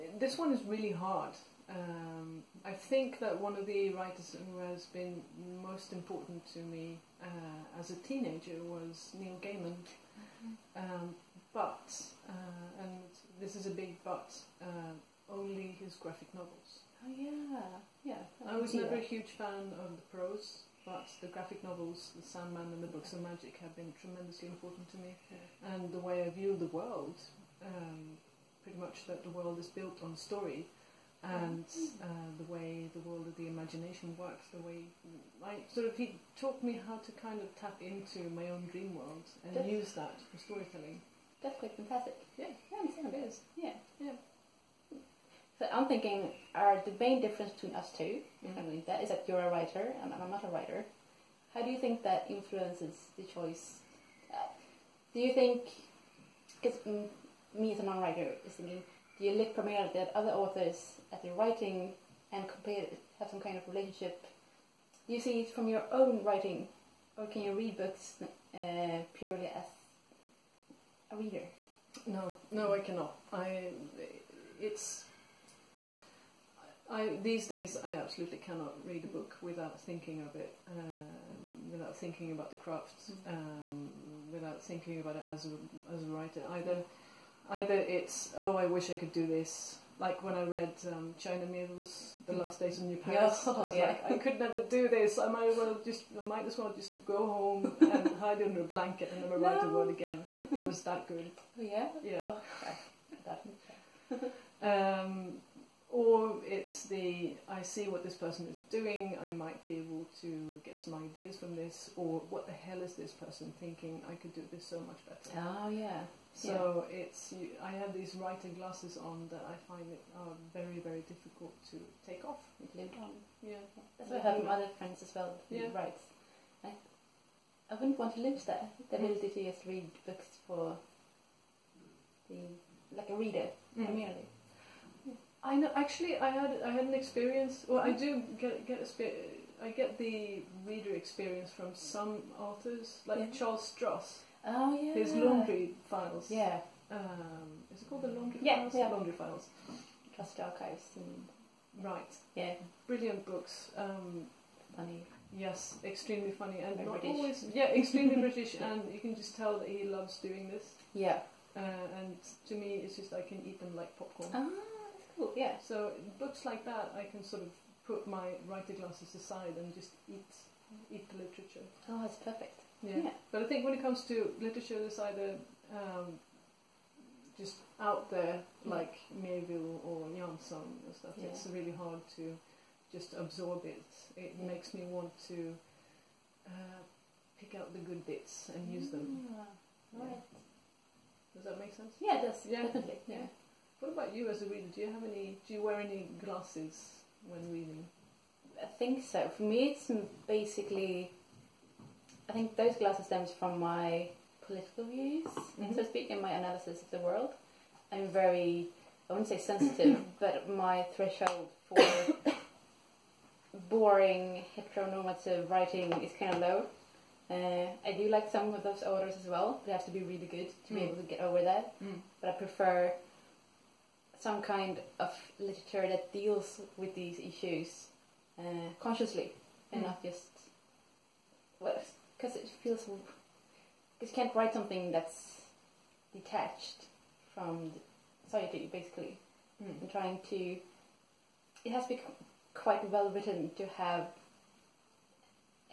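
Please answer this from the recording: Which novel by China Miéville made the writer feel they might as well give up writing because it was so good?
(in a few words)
The Last Days of New Paris.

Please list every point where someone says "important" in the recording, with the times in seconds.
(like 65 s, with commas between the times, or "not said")
5 s, 24 s.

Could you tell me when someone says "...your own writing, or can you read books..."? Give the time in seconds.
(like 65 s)
65 s.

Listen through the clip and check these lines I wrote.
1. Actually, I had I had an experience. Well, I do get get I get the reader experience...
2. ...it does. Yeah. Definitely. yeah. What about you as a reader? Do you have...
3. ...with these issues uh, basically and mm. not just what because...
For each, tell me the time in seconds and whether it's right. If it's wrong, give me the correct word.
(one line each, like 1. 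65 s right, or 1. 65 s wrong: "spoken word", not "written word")
1. 135 s right
2. 192 s right
3. 226 s wrong: "consciously", not "basically".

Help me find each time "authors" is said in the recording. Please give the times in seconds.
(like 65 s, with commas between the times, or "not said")
60 s, 142 s, 218 s.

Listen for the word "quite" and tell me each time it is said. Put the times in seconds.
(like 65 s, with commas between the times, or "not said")
41 s, 242 s.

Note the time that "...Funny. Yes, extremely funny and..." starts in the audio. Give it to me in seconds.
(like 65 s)
154 s.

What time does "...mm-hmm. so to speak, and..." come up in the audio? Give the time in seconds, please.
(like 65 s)
205 s.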